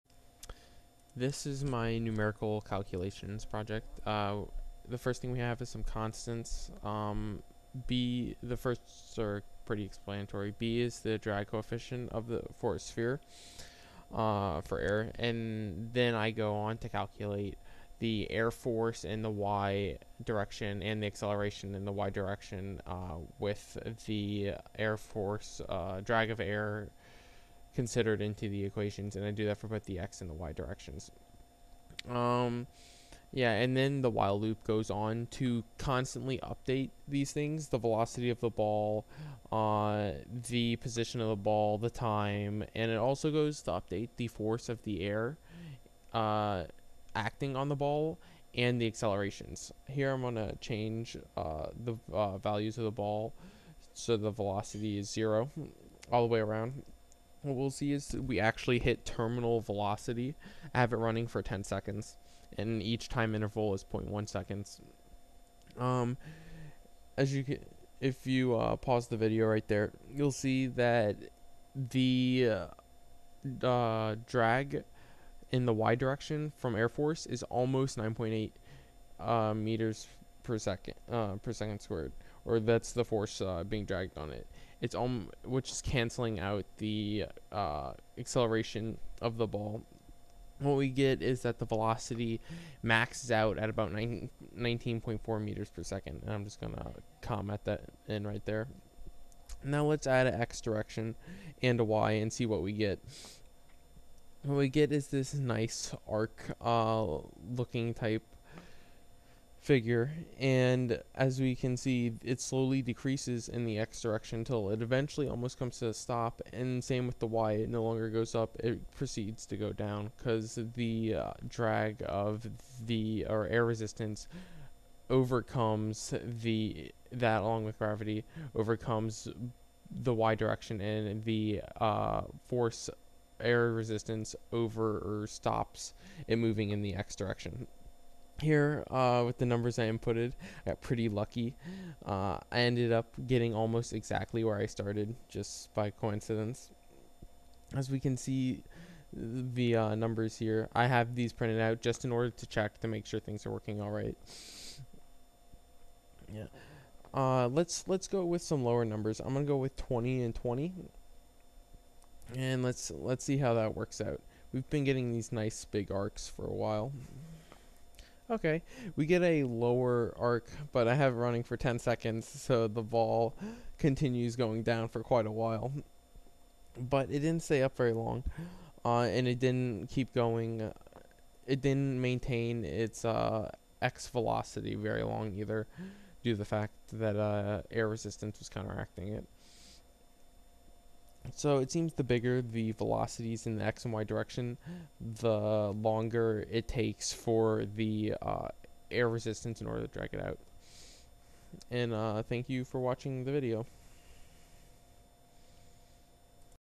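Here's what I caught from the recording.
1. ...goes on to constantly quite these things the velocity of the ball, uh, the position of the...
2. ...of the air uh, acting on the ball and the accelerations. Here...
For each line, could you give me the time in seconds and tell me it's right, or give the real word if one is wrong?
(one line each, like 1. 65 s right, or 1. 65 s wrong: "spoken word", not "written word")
1. 34 s wrong: "update", not "quite"
2. 44 s right.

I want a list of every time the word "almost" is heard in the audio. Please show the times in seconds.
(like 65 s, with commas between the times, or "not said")
77 s, 115 s, 143 s.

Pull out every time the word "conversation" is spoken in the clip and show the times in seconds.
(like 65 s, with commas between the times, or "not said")
not said.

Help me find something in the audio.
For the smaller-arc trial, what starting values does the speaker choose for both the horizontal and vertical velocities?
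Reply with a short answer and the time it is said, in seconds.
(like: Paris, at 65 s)
20 and 20, at 159 s.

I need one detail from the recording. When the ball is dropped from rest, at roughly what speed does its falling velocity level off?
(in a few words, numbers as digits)
19.4 meters per second.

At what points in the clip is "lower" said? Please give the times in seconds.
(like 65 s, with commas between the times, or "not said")
158 s, 169 s.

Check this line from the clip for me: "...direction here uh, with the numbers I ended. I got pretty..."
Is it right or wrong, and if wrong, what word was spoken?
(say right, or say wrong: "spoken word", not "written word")
wrong: "inputted", not "ended".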